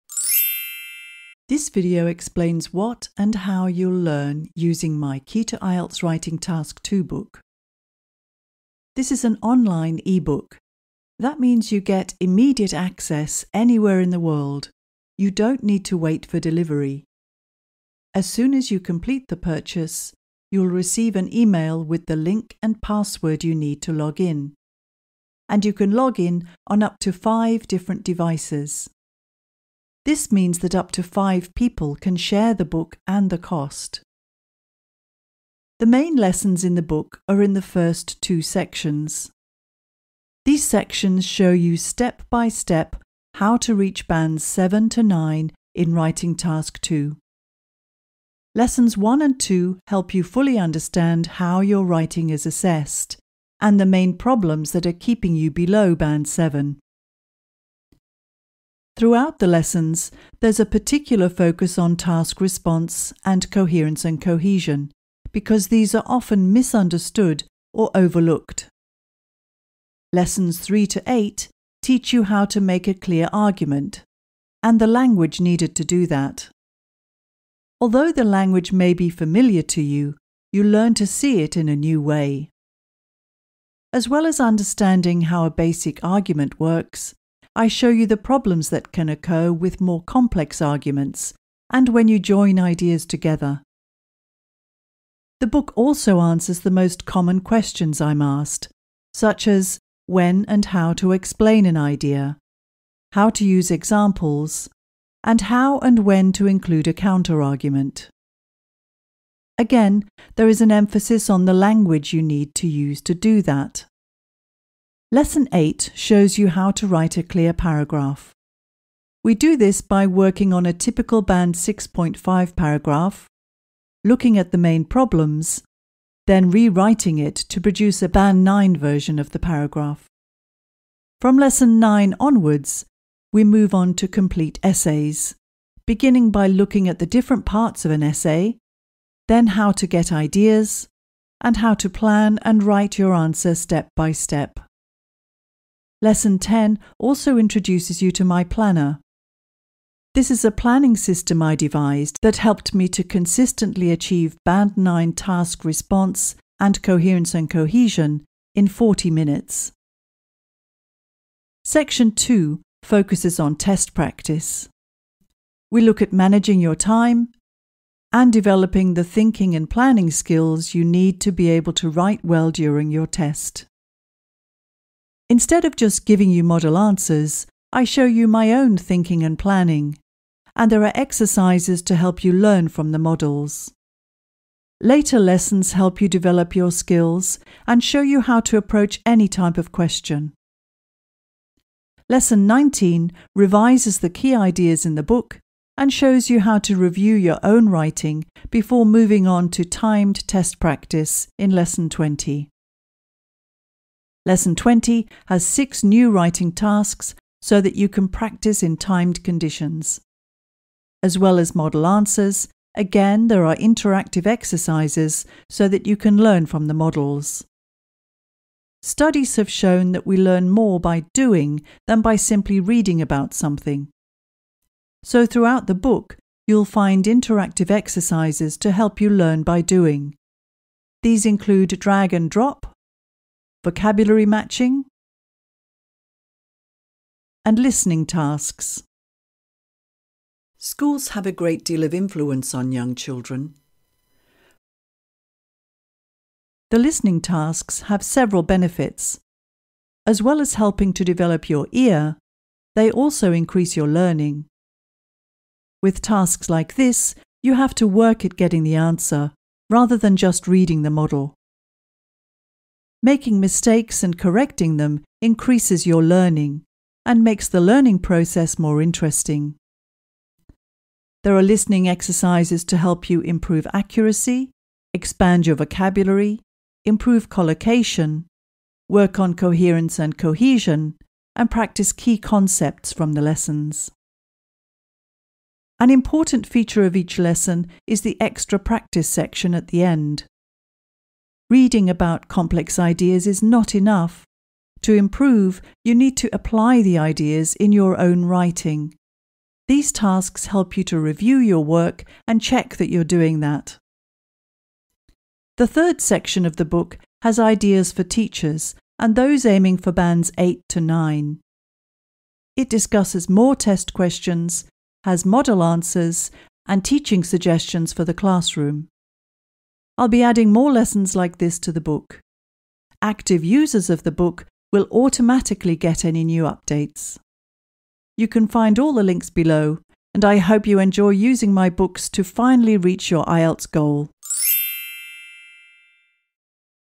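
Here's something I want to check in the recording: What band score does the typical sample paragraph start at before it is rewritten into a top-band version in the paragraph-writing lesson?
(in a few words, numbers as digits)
6.5.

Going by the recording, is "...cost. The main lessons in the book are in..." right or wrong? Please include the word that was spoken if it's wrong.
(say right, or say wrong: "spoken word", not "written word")
right.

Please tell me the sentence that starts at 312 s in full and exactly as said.
It discusses more test questions, has model answers, and teaching suggestions for the classroom.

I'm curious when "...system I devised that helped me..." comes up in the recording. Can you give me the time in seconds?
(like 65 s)
150 s.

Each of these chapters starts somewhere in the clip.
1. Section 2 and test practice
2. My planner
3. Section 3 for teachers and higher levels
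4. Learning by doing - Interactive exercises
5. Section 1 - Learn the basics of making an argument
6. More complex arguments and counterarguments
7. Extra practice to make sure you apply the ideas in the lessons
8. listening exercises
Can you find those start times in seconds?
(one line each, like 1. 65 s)
1. 160 s
2. 145 s
3. 305 s
4. 217 s
5. 49 s
6. 83 s
7. 284 s
8. 239 s.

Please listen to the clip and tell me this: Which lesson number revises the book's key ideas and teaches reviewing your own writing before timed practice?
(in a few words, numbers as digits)
19.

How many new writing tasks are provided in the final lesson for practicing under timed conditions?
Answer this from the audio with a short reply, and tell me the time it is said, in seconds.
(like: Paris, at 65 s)
6, at 205 s.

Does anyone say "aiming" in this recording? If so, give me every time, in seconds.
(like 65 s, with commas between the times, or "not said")
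309 s.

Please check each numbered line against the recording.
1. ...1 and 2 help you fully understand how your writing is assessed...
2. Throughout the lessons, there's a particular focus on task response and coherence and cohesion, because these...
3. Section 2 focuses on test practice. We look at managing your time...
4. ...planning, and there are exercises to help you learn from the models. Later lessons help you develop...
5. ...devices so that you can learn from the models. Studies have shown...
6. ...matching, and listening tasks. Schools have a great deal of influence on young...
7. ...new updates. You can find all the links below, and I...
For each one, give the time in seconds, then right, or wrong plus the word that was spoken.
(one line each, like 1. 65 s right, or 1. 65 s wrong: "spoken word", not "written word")
1. 48 s right
2. 58 s right
3. 161 s right
4. 179 s right
5. 214 s wrong: "exercises", not "devices"
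6. 234 s right
7. 326 s right.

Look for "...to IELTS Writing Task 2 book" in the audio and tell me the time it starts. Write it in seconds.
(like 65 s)
5 s.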